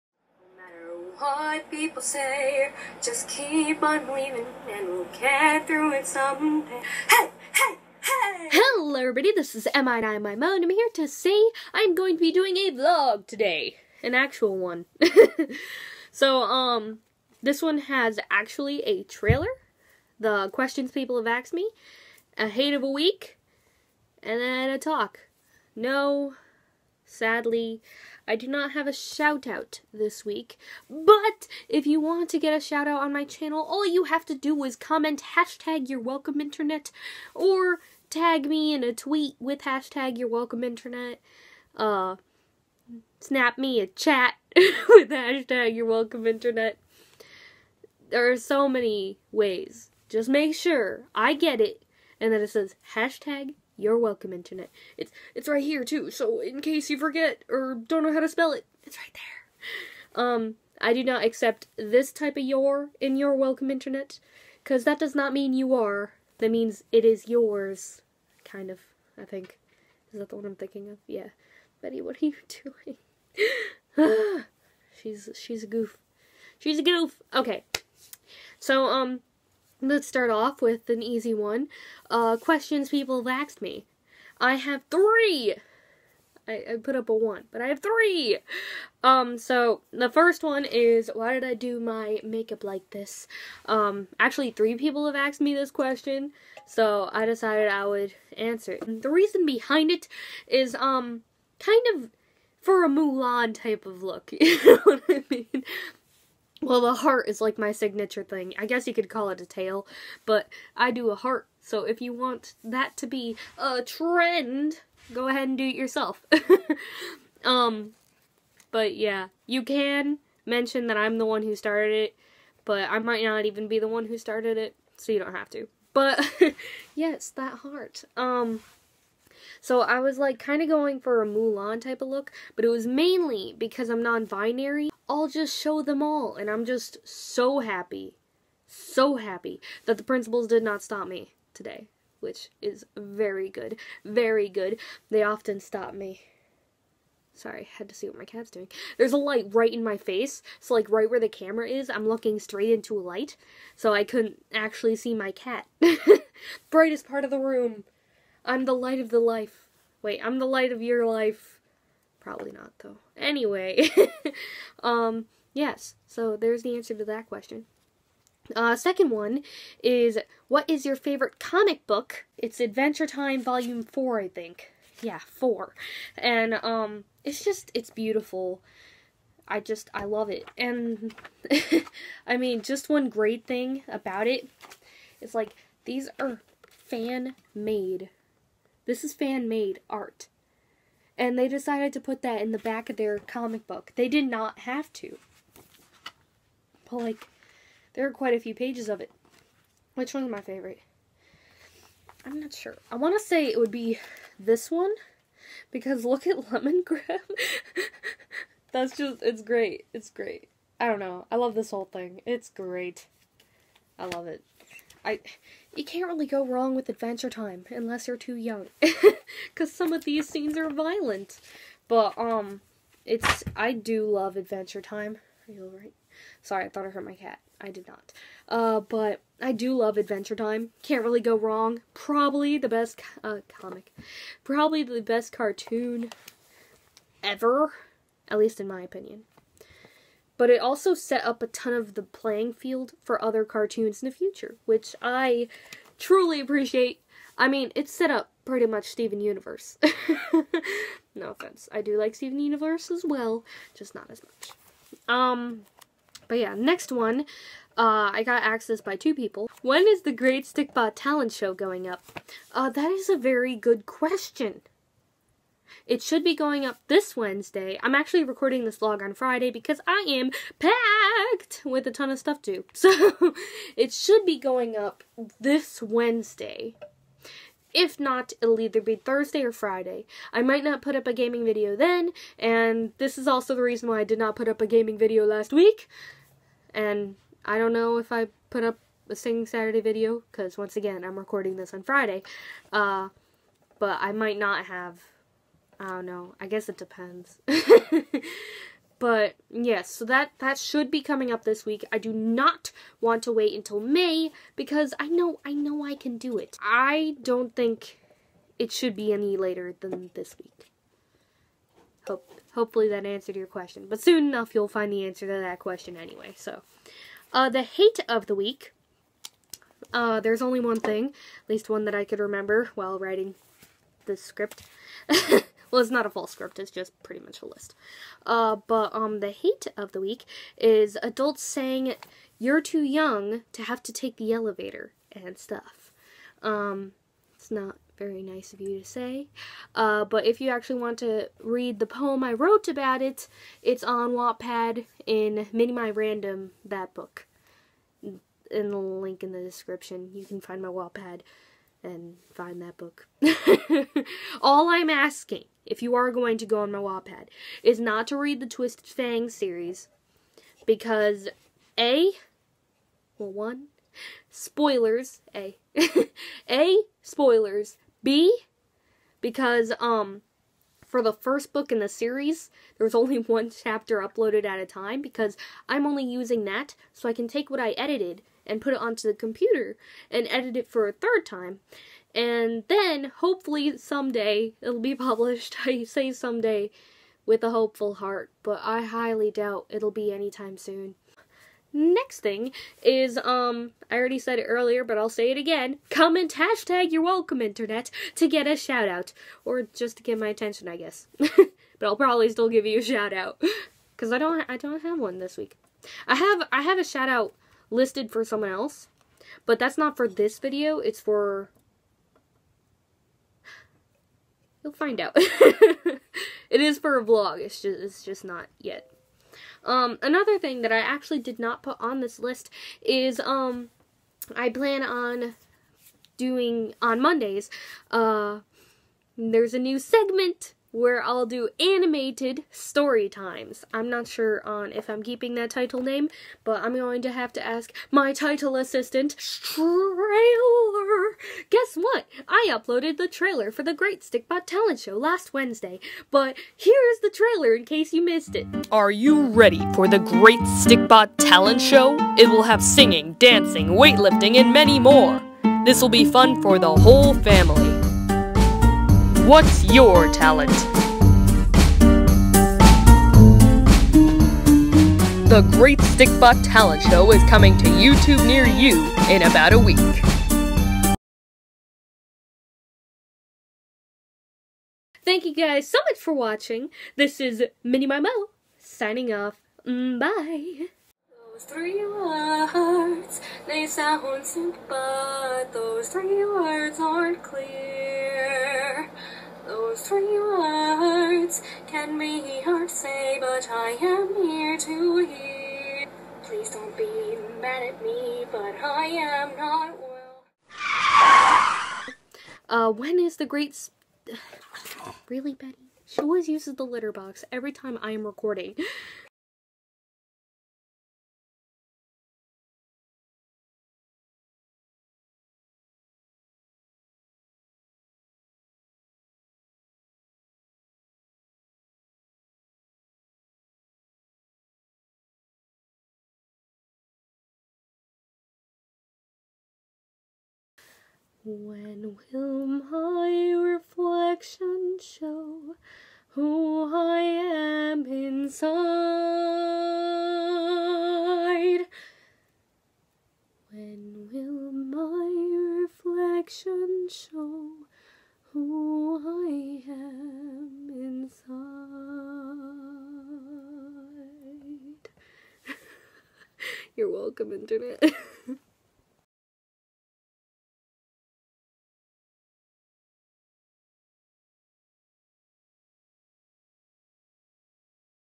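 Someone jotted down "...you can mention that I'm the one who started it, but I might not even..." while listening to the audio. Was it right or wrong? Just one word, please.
right.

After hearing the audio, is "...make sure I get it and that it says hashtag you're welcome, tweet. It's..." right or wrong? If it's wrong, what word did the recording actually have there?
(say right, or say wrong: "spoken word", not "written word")
wrong: "internet", not "tweet".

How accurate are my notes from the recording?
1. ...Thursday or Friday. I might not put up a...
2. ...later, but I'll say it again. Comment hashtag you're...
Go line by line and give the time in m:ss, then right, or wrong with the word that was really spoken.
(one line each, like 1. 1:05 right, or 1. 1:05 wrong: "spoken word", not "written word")
1. 4:38 right
2. 6:34 wrong: "earlier", not "later".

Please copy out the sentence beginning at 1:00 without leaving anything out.
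Um, I do not accept this type of your in your welcome, internet, because that does not mean you are.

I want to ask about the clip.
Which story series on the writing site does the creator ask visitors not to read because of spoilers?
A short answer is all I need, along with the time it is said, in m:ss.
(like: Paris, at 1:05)
Twisted Fang, at 5:58.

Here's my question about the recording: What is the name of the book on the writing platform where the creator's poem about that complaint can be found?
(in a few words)
Mini My Random.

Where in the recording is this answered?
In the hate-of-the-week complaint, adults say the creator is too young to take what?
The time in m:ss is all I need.
5:34.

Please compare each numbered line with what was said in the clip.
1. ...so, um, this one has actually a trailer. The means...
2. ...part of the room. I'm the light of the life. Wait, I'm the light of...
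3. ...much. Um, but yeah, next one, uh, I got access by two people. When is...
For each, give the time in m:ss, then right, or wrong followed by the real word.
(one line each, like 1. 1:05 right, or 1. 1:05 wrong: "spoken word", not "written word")
1. 0:16 wrong: "questions", not "means"
2. 2:37 right
3. 4:14 right.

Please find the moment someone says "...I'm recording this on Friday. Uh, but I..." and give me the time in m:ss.
4:51.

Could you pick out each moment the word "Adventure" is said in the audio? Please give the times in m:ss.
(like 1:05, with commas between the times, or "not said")
2:52, 3:36, 3:44, 3:49.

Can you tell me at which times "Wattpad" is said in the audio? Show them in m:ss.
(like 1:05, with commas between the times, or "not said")
5:44, 5:50, 5:56.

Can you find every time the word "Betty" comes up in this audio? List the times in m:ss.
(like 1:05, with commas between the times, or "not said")
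1:11, 8:25.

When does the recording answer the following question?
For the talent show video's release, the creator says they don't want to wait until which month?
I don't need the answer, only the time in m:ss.
5:03.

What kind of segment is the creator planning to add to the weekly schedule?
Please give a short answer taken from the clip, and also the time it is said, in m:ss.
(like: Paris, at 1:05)
Animated story times, at 7:11.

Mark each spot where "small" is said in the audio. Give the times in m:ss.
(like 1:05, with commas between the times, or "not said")
not said.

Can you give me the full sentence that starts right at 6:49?
But that's not for this video, it's for...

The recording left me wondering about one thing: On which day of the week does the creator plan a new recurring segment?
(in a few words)
Mondays.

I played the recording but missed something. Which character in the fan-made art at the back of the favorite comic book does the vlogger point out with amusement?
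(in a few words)
Lemongrab.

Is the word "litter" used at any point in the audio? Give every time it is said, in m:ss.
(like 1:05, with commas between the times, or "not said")
8:26.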